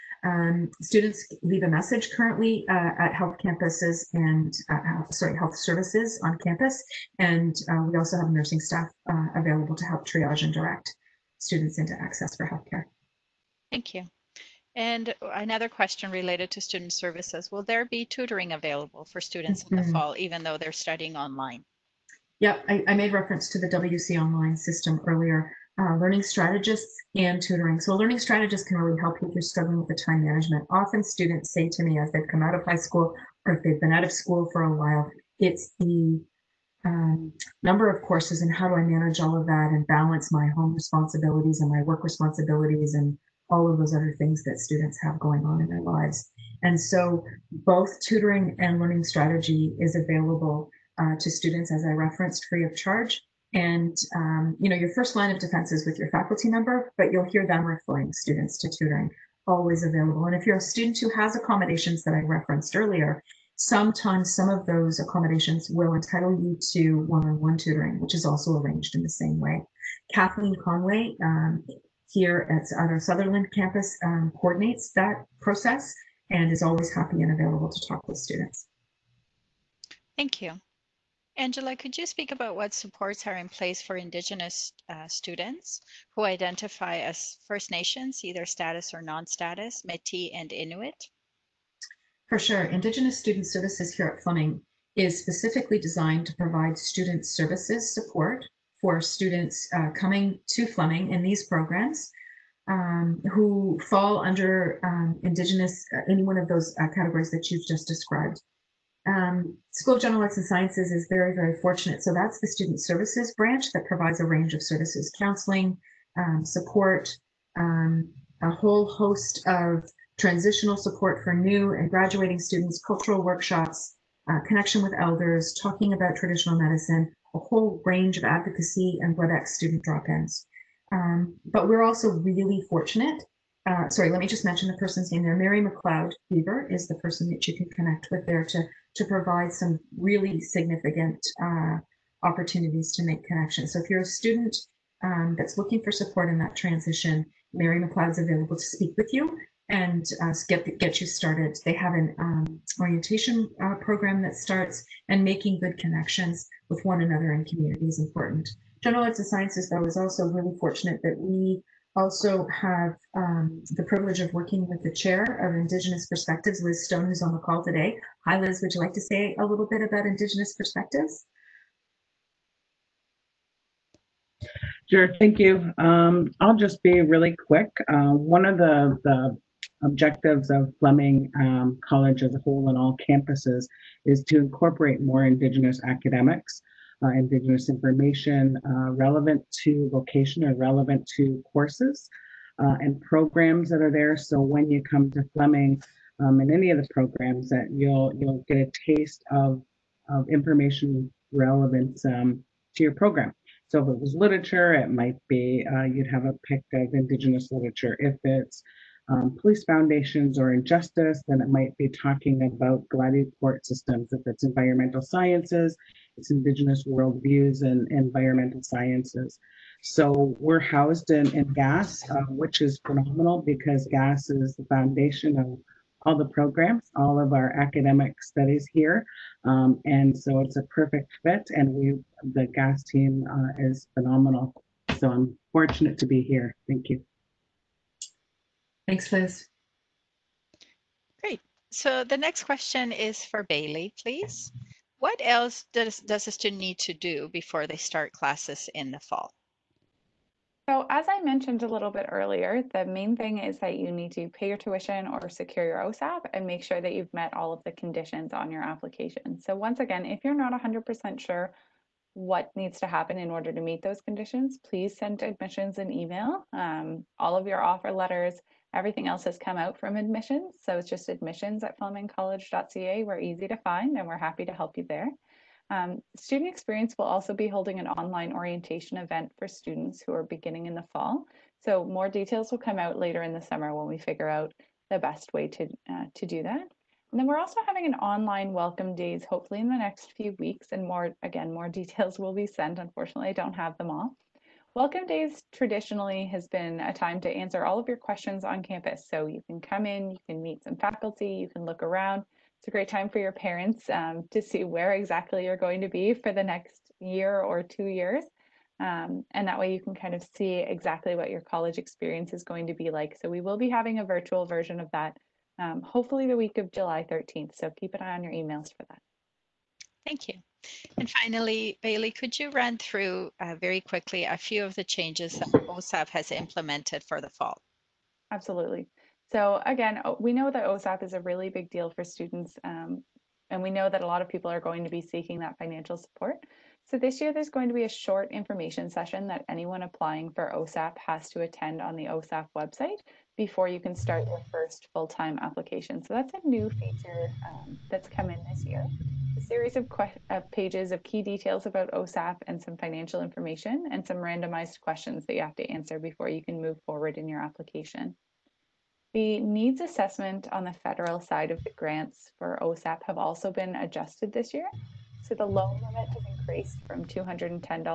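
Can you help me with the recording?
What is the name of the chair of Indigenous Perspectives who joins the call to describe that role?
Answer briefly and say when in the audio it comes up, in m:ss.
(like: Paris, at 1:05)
Liz Stone, at 2:46.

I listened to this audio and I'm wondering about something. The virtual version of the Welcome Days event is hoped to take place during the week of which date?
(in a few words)
July 13.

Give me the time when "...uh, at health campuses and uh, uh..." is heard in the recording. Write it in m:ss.
0:02.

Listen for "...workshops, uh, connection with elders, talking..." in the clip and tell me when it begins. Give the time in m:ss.
2:03.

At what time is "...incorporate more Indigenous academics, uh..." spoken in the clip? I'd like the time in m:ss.
3:04.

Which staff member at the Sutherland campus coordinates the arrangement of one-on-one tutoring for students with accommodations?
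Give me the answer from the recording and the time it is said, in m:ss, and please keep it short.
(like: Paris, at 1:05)
Kathleen Conway, at 1:10.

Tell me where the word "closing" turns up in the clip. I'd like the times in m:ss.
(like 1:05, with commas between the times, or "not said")
not said.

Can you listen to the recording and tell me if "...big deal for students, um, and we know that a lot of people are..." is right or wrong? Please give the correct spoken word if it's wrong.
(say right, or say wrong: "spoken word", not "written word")
right.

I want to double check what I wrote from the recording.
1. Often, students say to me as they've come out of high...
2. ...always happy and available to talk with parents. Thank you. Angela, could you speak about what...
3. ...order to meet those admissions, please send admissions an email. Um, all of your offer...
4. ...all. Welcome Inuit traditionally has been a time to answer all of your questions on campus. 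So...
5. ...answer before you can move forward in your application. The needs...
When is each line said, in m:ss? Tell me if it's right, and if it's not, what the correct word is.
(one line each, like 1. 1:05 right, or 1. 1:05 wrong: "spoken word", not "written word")
1. 0:30 right
2. 1:16 wrong: "students", not "parents"
3. 4:23 wrong: "conditions", not "admissions"
4. 4:53 wrong: "Days", not "Inuit"
5. 5:55 right.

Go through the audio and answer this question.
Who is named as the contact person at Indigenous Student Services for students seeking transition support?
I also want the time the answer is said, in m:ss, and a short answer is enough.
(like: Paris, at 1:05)
Mary McLeod Beaver, at 2:15.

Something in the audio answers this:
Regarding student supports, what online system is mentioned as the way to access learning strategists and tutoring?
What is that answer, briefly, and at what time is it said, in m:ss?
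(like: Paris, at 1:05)
WC online, at 0:23.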